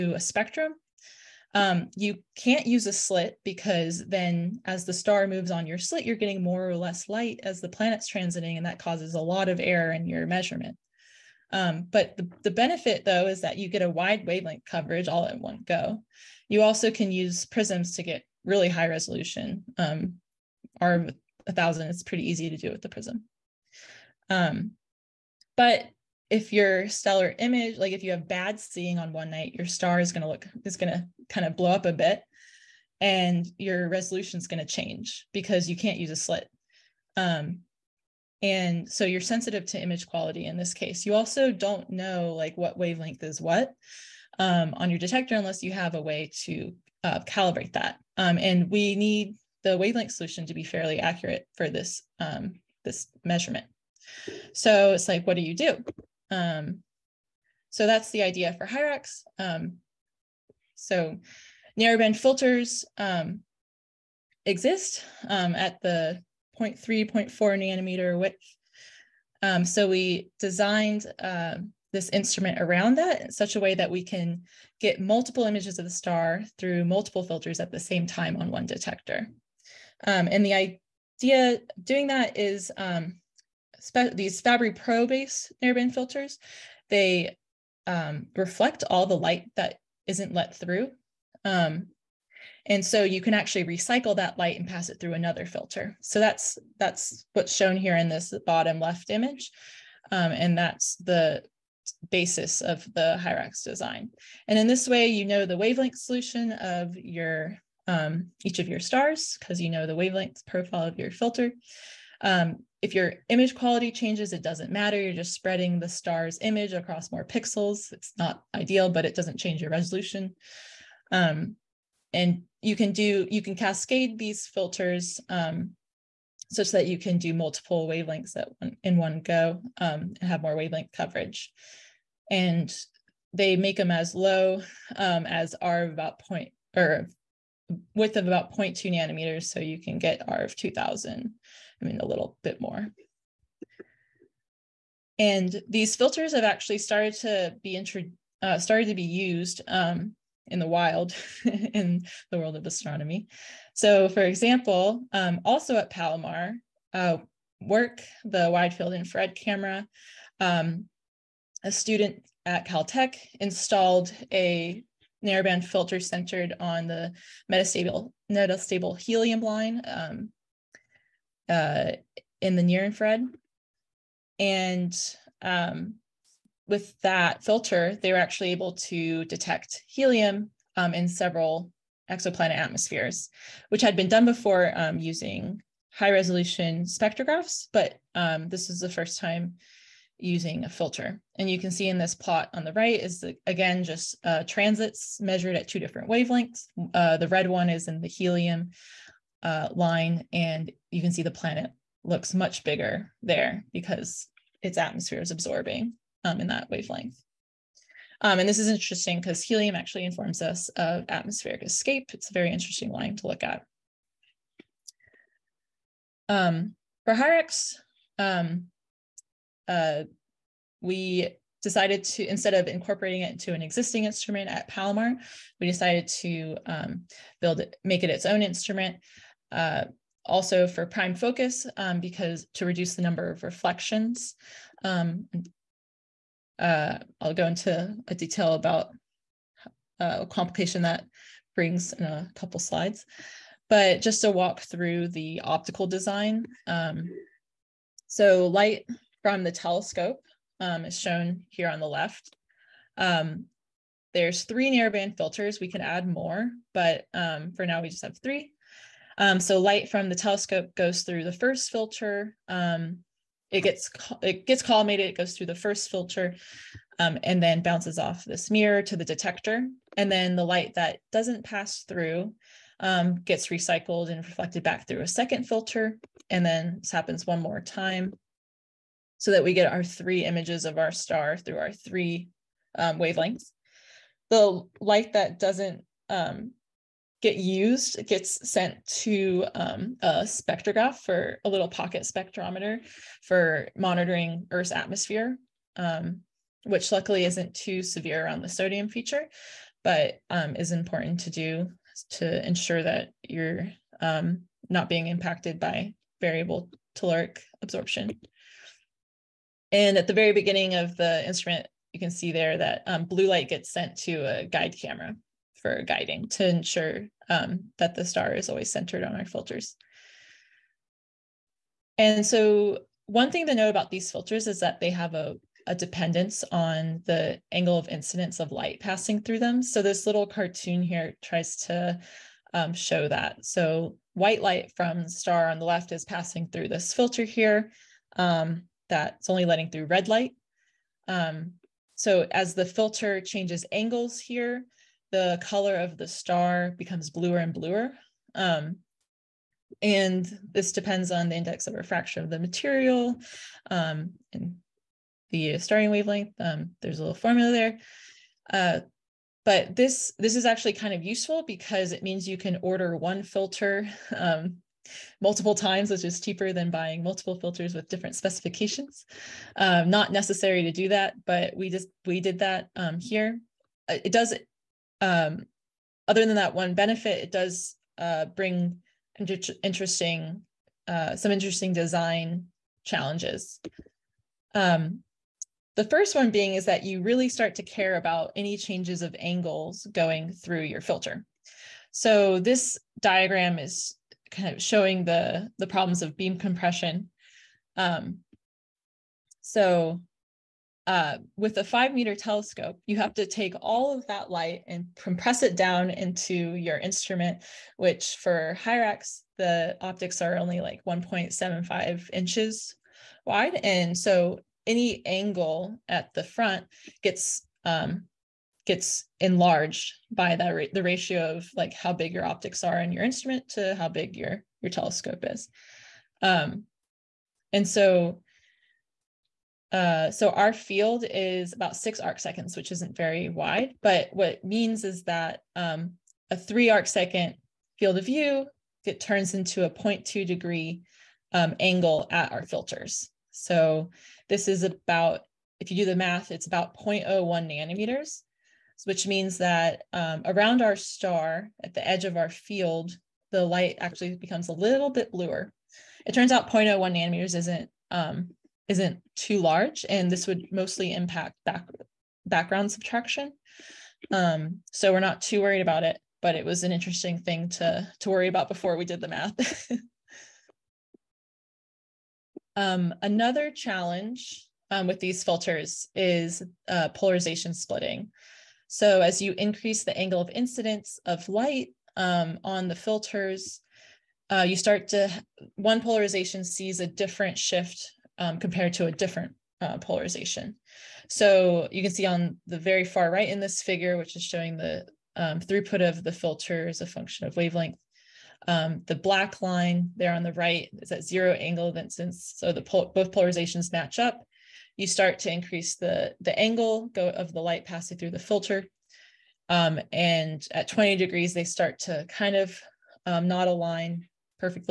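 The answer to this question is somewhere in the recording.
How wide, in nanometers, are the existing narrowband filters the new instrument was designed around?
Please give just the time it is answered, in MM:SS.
01:06.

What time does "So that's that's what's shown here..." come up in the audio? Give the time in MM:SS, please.
01:36.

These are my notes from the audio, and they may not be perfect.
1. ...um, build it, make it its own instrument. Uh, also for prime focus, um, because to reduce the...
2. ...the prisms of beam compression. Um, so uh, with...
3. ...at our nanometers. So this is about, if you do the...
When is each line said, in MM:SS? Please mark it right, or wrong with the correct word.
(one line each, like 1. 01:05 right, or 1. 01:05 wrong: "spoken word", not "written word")
1. 03:46 right
2. 06:35 wrong: "problems", not "prisms"
3. 07:22 wrong: "filters", not "nanometers".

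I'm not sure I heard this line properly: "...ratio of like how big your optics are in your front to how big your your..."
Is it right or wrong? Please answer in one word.
wrong.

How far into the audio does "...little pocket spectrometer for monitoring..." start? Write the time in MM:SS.
04:51.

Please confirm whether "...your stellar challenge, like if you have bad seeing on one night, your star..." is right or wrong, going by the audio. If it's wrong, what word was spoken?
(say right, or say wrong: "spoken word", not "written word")
wrong: "image", not "challenge".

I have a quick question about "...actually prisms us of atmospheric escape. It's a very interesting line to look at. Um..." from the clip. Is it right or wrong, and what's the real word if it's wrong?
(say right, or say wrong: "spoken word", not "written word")
wrong: "informs", not "prisms".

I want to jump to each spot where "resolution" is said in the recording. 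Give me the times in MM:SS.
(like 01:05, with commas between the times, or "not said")
00:18, 00:33, 01:59, 03:06.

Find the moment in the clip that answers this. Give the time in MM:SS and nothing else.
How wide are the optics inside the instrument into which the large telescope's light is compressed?
06:50.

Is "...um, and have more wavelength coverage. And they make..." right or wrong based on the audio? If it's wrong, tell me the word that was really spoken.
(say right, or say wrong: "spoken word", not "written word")
right.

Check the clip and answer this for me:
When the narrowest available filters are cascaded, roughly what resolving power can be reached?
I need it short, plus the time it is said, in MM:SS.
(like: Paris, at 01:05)
2000, at 02:20.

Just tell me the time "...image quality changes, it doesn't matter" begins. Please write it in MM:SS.
01:53.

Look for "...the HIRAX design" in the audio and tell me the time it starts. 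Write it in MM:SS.
01:42.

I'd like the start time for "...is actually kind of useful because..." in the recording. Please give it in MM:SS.
06:00.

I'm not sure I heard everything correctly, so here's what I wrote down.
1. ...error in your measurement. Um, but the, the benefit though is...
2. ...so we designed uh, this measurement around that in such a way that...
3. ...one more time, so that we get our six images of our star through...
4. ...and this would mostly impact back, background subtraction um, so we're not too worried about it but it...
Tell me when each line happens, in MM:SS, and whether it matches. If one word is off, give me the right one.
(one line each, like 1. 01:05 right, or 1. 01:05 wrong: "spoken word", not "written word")
1. 00:09 right
2. 01:09 wrong: "instrument", not "measurement"
3. 04:37 wrong: "three", not "six"
4. 07:39 right.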